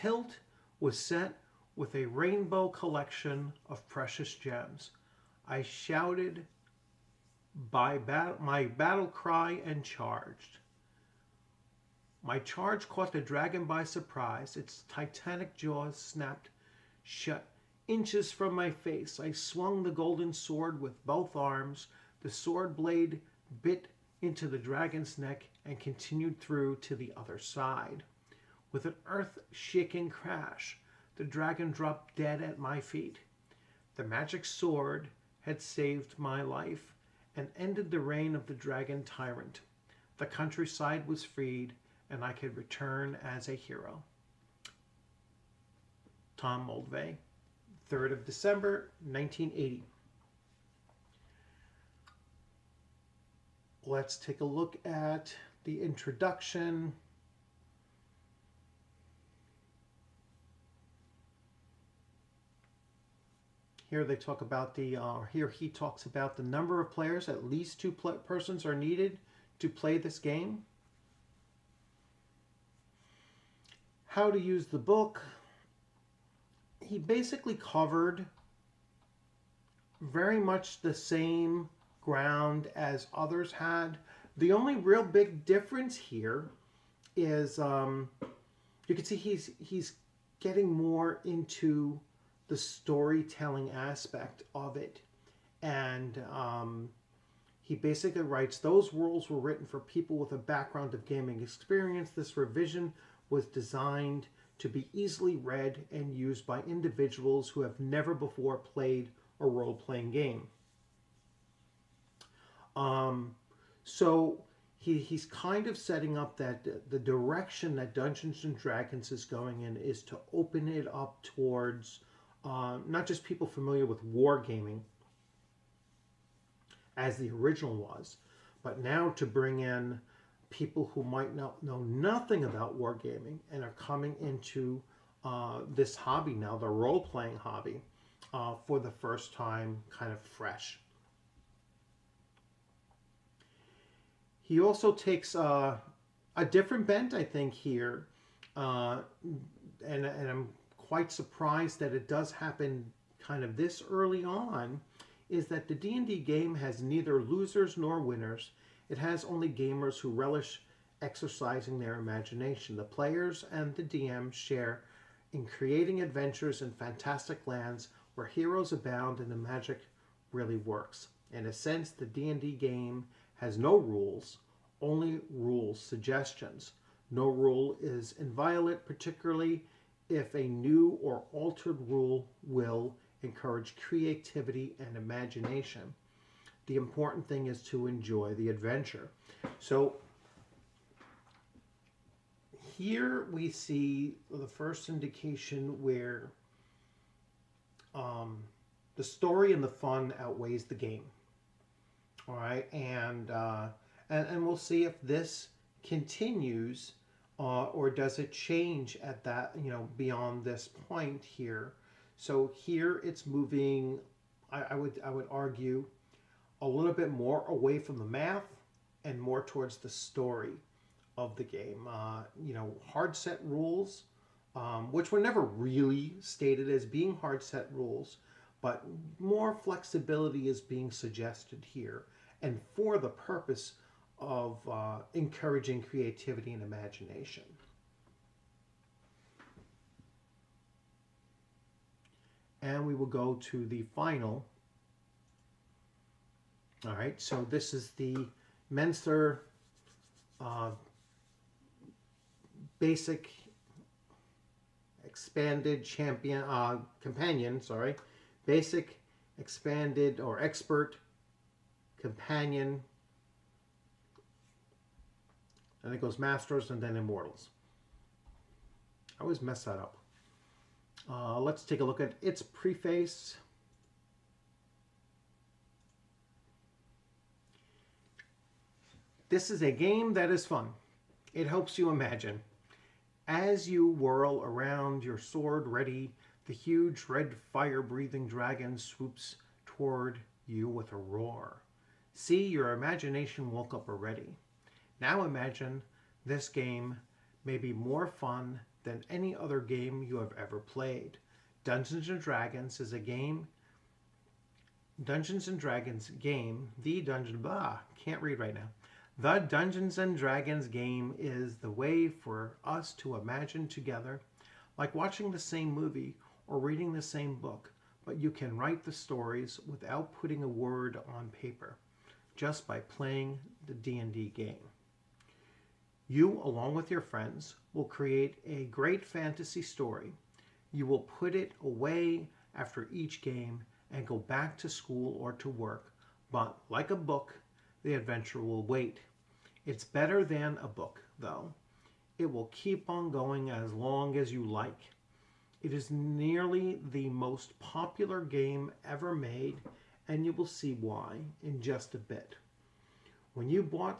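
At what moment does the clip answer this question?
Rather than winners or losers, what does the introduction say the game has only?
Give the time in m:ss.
2:39.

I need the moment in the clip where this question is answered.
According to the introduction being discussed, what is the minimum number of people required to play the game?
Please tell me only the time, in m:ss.
1:07.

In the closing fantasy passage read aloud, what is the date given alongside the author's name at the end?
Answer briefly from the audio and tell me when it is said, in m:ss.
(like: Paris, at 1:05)
3rd of December, 1980, at 0:47.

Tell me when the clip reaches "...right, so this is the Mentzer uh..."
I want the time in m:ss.
4:06.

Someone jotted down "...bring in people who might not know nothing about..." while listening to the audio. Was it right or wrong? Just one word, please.
right.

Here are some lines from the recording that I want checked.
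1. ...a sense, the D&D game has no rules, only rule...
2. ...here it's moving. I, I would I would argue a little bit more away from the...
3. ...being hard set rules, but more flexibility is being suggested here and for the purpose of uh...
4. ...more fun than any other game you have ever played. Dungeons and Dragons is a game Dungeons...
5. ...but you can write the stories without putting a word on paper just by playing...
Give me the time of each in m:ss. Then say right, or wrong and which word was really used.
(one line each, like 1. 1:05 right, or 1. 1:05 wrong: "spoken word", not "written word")
1. 2:51 right
2. 3:32 right
3. 3:46 right
4. 4:57 right
5. 5:18 right.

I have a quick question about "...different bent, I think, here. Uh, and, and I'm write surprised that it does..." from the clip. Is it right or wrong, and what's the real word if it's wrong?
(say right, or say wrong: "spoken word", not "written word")
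wrong: "quite", not "write".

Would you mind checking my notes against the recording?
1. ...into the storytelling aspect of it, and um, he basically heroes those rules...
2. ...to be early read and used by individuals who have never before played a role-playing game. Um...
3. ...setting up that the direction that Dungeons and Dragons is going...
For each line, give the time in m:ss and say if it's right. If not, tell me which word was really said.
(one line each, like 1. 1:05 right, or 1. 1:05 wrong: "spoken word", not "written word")
1. 1:31 wrong: "writes", not "heroes"
2. 1:44 wrong: "easily", not "early"
3. 1:55 right.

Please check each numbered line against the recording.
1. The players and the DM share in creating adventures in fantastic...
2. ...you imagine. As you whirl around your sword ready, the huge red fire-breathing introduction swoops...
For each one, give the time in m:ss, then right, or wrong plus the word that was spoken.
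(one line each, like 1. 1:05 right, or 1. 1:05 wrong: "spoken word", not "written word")
1. 2:42 right
2. 4:41 wrong: "dragon", not "introduction".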